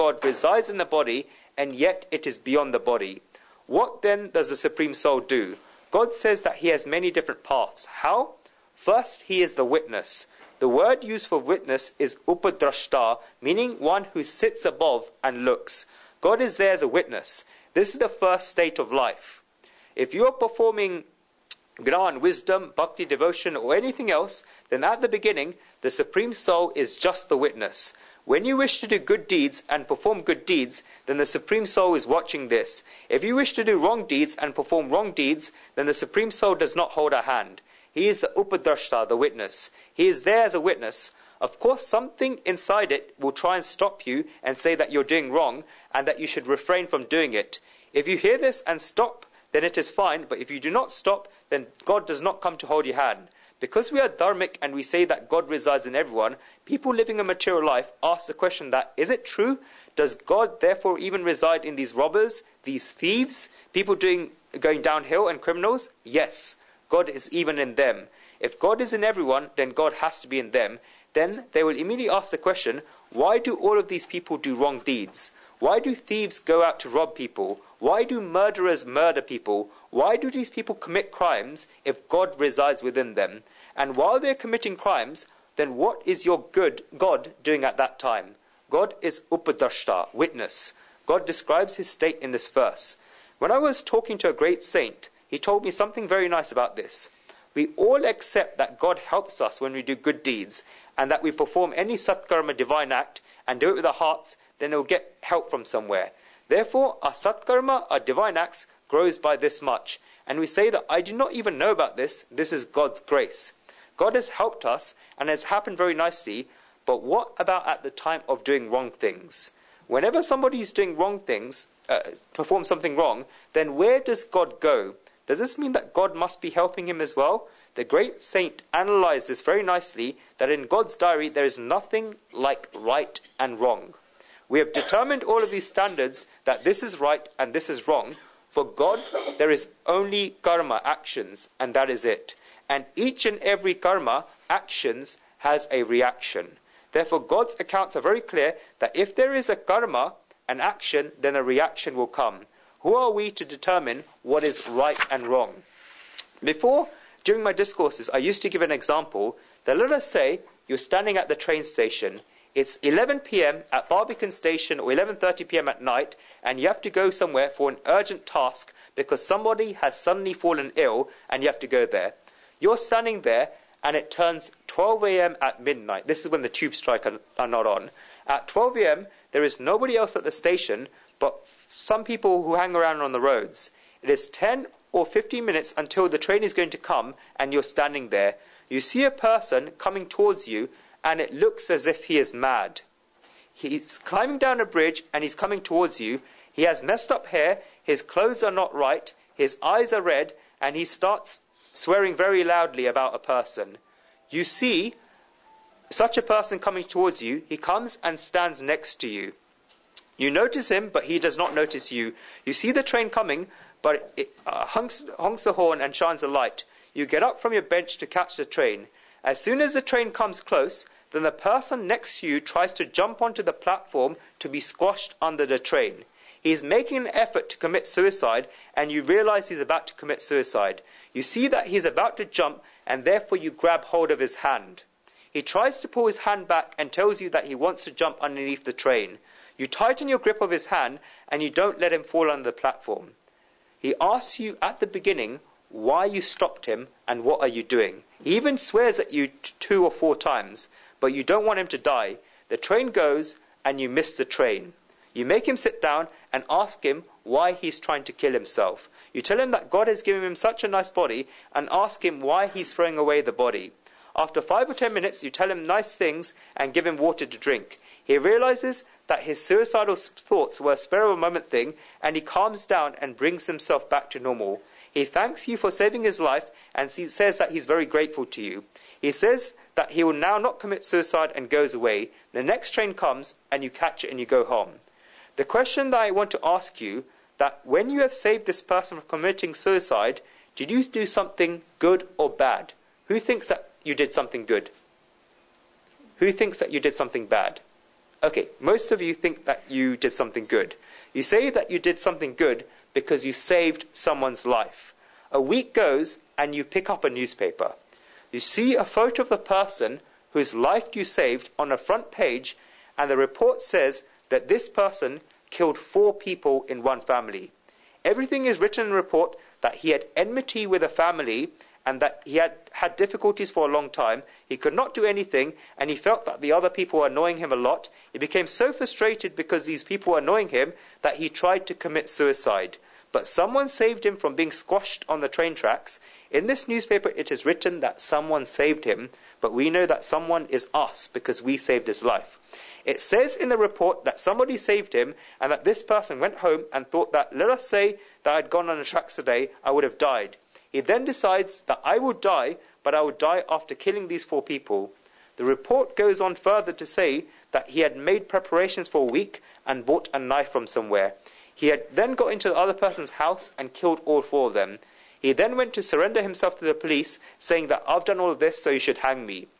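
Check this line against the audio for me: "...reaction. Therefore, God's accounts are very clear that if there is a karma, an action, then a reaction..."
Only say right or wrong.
right.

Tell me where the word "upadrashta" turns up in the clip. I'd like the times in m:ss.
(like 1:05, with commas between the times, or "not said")
0:12, 0:38, 1:29.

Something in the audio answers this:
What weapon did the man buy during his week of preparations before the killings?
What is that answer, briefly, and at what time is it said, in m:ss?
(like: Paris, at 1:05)
a knife, at 6:00.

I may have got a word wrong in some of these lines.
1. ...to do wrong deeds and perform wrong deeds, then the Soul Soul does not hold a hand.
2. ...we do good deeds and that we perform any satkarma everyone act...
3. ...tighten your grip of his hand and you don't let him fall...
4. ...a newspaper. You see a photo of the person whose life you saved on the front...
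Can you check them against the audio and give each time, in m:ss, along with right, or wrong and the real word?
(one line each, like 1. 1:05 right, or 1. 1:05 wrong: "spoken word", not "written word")
1. 0:33 wrong: "Supreme", not "Soul"
2. 1:39 wrong: "divine", not "everyone"
3. 3:59 right
4. 5:07 right.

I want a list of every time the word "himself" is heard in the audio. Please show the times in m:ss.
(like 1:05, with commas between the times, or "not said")
4:18, 4:33, 6:06.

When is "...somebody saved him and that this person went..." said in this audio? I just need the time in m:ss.
5:44.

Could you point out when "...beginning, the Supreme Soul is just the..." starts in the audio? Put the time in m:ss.
0:25.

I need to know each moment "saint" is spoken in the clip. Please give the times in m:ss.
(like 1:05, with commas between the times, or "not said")
1:34, 2:08.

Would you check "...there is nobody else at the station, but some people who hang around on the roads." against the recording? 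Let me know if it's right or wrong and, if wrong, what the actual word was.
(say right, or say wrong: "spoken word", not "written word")
right.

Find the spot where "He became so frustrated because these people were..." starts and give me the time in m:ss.
5:28.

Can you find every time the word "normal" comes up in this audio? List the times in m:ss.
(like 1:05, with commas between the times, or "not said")
4:34.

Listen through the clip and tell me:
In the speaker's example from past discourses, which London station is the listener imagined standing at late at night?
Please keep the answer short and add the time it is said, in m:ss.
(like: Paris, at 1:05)
Barbican Station, at 2:43.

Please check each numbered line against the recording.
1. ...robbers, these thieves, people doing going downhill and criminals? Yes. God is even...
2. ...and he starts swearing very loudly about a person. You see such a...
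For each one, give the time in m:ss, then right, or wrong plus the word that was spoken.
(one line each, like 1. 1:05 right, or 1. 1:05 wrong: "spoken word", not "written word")
1. 1:01 right
2. 3:20 right.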